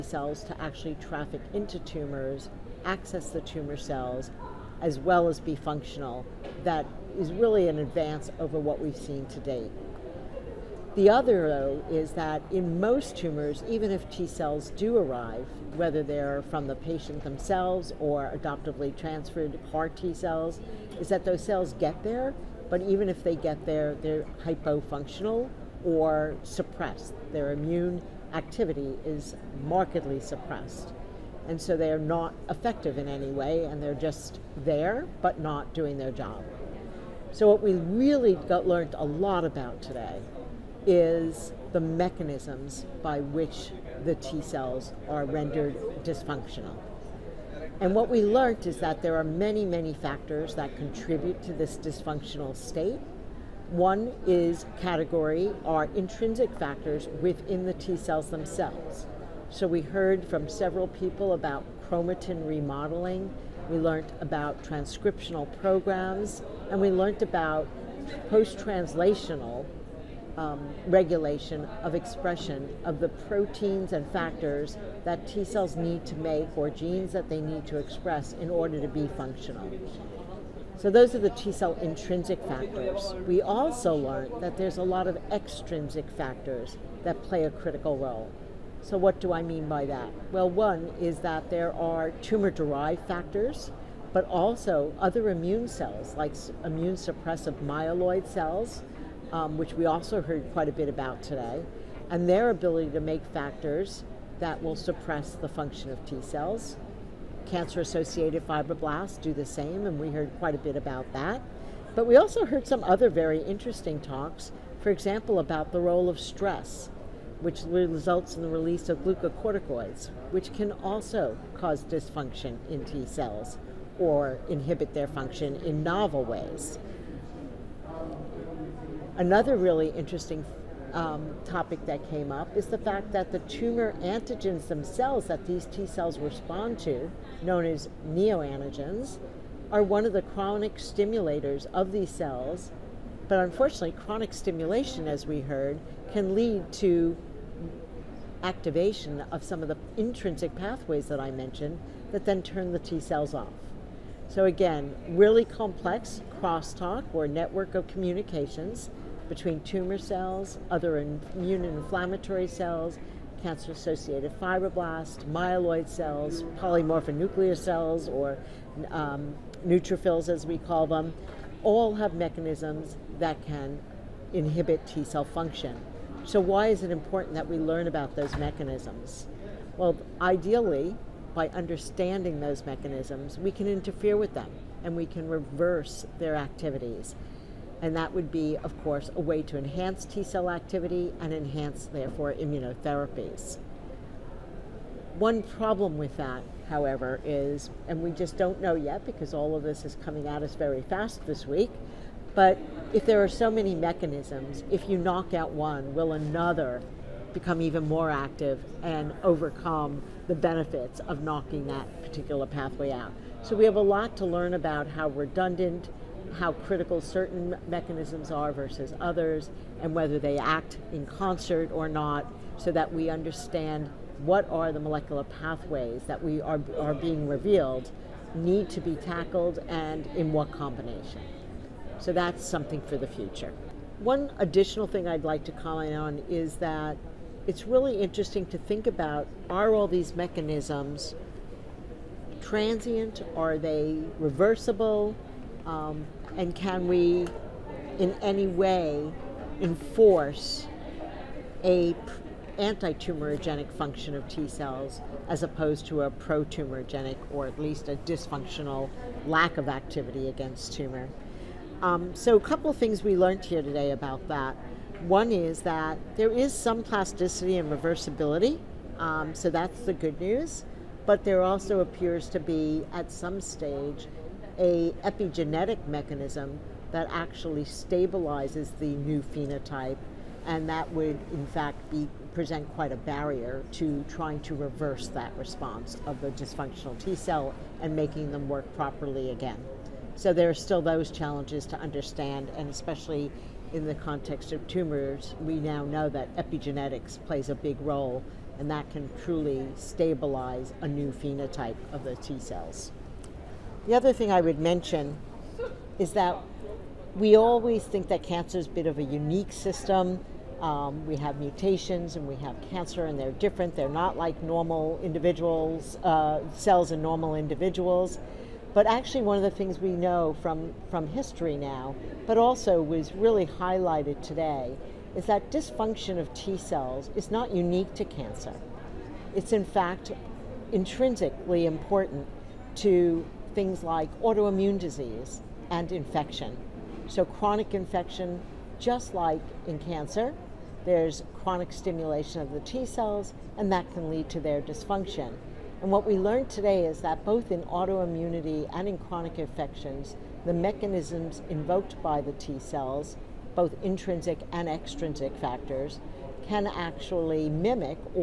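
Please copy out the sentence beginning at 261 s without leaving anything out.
Um, so a couple of things we learned here today about that.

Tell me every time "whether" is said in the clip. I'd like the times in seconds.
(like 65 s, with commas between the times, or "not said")
15 s, 219 s.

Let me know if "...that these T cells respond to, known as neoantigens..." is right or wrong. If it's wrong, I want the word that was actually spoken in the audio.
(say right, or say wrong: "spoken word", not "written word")
right.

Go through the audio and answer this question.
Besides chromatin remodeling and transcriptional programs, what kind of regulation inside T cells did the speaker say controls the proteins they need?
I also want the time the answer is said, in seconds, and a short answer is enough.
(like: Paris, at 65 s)
post-translational, at 68 s.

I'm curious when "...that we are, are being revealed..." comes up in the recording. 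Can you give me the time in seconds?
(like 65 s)
226 s.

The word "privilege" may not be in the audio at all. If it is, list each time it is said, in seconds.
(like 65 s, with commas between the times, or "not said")
not said.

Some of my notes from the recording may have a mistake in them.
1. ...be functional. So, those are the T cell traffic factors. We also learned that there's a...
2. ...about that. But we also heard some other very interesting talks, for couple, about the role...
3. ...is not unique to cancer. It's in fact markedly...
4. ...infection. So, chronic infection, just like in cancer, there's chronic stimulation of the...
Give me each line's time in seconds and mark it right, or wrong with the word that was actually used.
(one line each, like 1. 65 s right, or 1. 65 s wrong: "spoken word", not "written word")
1. 78 s wrong: "intrinsic", not "traffic"
2. 110 s wrong: "example", not "couple"
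3. 327 s wrong: "intrinsically", not "markedly"
4. 335 s right.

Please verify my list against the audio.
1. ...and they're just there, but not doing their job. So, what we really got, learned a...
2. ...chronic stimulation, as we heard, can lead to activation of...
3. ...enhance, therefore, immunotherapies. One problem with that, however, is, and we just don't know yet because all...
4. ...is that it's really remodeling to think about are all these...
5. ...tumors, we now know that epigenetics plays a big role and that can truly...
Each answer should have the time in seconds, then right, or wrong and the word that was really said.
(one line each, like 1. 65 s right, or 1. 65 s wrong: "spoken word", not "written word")
1. 33 s right
2. 143 s right
3. 191 s right
4. 236 s wrong: "interesting", not "remodeling"
5. 294 s right.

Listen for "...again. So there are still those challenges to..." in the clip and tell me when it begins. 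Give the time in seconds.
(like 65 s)
289 s.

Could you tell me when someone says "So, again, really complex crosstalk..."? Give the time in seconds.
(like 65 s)
154 s.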